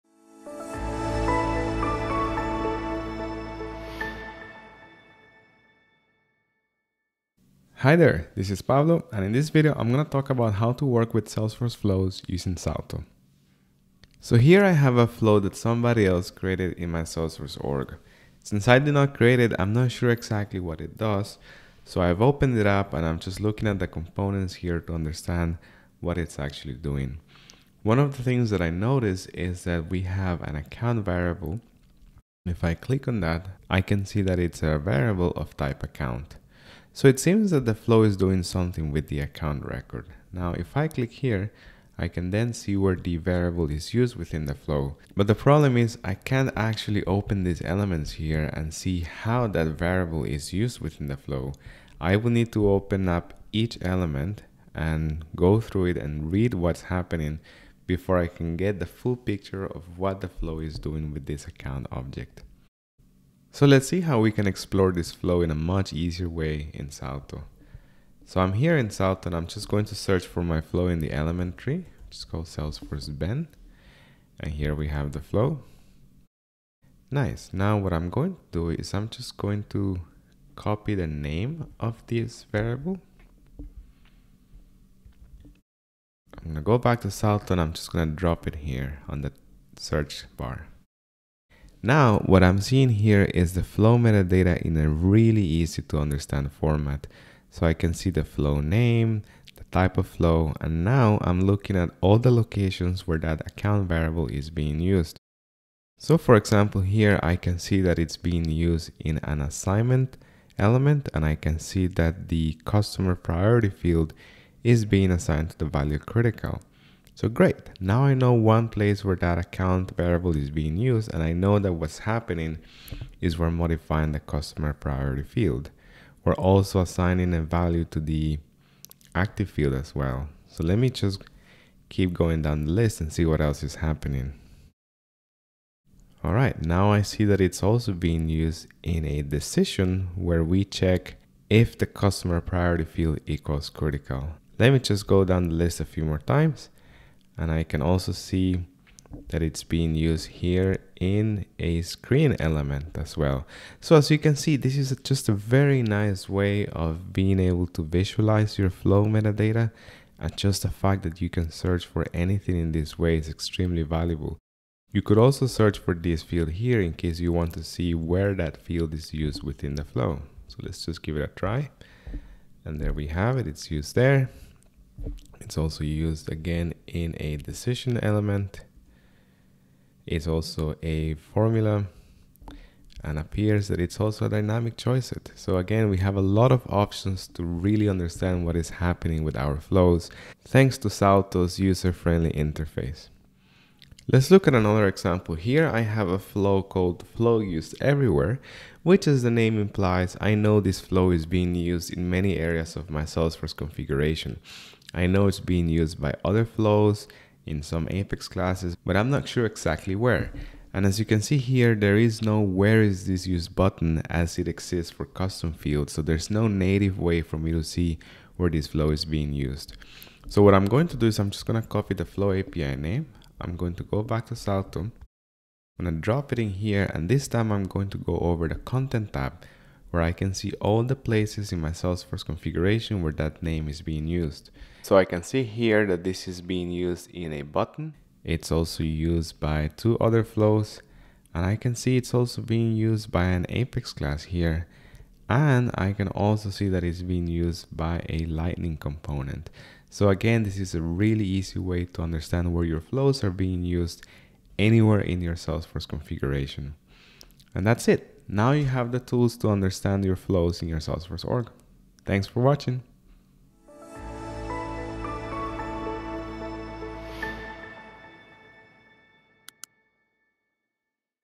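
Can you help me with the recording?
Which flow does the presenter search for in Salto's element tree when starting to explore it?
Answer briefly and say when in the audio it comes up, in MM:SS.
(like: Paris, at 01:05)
Salesforce Ben, at 01:12.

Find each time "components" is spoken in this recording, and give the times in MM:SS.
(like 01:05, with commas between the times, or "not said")
00:23, 04:08.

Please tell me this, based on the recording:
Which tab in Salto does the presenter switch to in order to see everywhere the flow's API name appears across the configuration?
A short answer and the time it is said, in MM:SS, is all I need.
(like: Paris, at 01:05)
content tab, at 03:48.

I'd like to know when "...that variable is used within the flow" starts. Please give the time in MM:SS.
00:49.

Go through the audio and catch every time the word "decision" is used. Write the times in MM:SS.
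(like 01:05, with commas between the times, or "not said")
02:19, 02:57.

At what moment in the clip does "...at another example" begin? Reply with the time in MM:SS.
03:14.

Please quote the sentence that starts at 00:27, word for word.
One of the things that I notice is that we have an account variable.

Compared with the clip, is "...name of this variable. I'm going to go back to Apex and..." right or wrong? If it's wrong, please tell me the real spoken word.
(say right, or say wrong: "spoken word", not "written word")
wrong: "Salto", not "Apex".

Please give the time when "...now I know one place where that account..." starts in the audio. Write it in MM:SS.
01:57.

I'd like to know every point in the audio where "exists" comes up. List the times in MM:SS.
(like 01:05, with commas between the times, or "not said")
03:34.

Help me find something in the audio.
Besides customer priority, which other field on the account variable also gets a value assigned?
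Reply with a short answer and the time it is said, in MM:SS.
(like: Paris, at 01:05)
active, at 02:09.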